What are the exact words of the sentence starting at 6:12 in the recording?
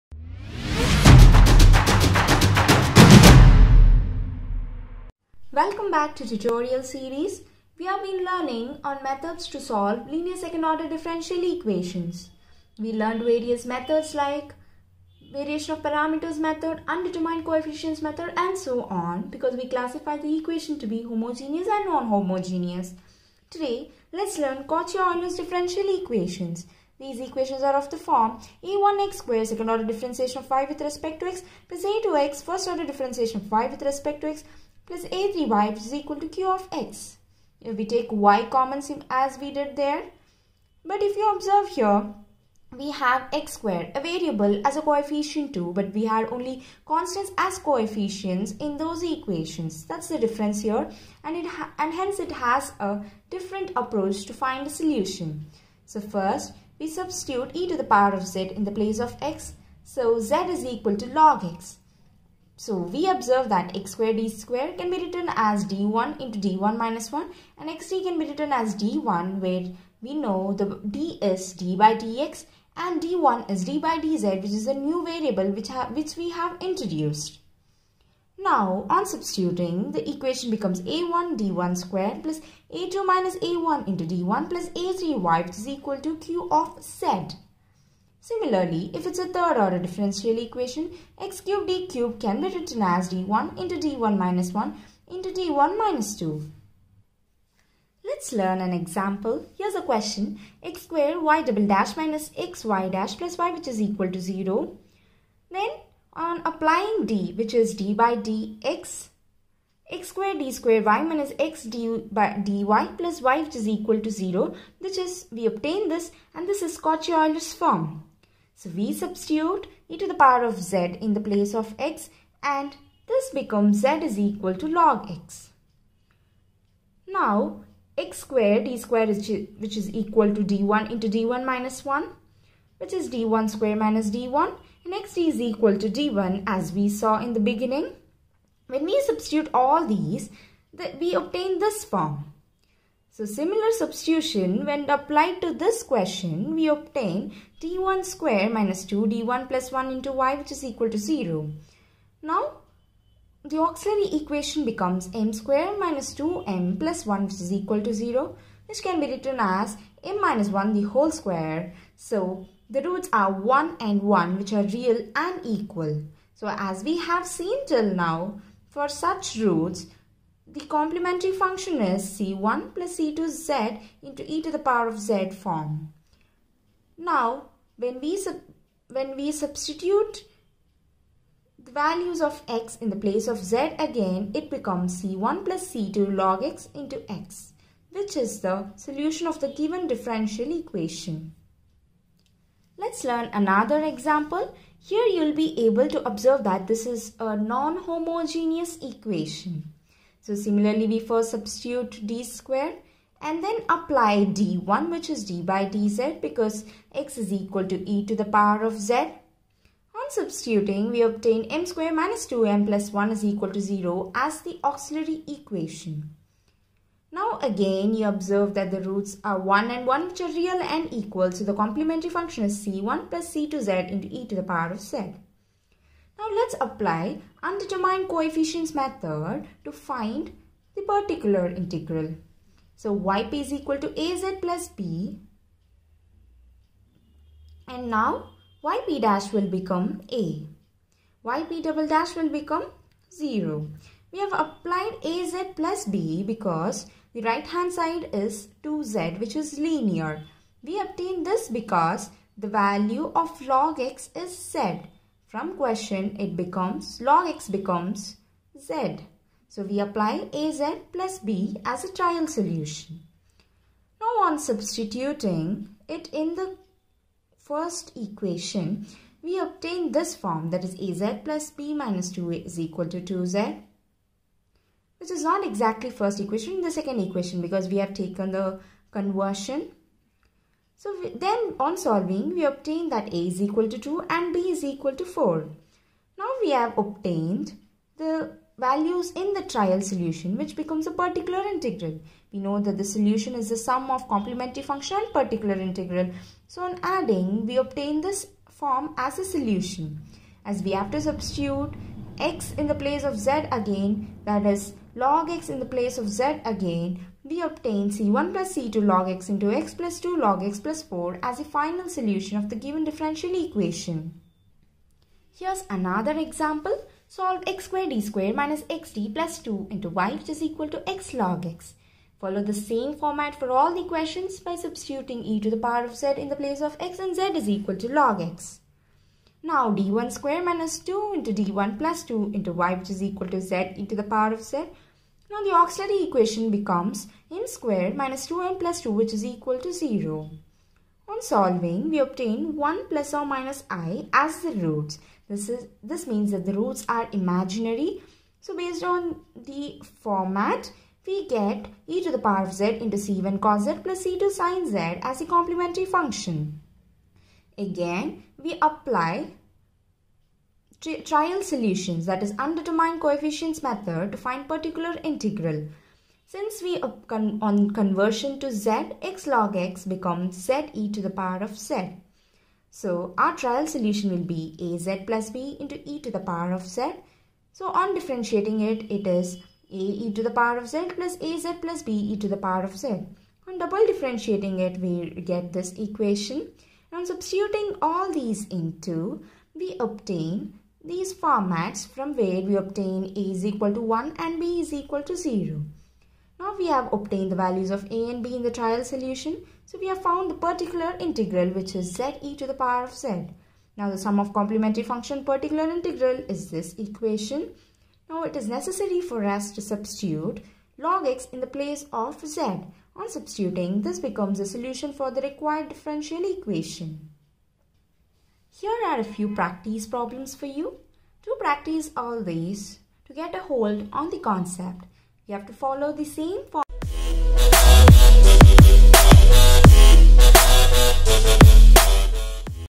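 So our trial solution will be az plus b into e to the power of z.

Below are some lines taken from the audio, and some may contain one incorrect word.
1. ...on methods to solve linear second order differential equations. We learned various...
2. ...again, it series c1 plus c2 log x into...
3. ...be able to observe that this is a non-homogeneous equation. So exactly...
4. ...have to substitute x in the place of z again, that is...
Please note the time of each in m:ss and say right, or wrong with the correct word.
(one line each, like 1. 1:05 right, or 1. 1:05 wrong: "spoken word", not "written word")
1. 0:08 right
2. 3:03 wrong: "becomes", not "series"
3. 3:15 wrong: "similarly", not "exactly"
4. 5:00 right.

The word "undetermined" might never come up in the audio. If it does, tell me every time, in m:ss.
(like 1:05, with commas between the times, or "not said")
0:16, 3:47, 6:02.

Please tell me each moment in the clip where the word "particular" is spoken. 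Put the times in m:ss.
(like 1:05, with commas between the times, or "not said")
3:50, 4:51, 4:55, 6:04, 6:40, 6:45.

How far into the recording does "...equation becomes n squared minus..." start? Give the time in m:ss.
5:36.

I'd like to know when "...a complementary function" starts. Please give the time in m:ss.
5:55.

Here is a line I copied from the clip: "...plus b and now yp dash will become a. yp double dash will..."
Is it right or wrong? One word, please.
right.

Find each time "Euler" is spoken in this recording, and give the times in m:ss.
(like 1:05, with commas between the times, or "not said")
0:24, 1:56.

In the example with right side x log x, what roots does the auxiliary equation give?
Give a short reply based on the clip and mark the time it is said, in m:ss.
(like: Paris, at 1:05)
1 plus or minus i, at 5:42.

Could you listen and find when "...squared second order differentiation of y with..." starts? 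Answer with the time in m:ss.
0:29.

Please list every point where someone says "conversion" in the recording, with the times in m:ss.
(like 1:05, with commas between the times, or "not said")
4:38, 6:07.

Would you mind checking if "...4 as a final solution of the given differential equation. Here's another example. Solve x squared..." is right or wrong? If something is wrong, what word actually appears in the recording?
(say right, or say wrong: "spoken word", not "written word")
right.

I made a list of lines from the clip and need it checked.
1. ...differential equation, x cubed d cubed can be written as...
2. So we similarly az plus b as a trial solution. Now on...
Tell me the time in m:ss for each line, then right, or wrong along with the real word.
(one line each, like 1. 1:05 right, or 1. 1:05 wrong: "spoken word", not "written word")
1. 1:29 right
2. 4:19 wrong: "apply", not "similarly".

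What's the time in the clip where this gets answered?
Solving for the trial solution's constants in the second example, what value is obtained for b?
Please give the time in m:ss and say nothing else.
4:44.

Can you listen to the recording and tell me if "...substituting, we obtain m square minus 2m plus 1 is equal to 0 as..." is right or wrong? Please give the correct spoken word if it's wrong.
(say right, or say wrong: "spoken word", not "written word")
right.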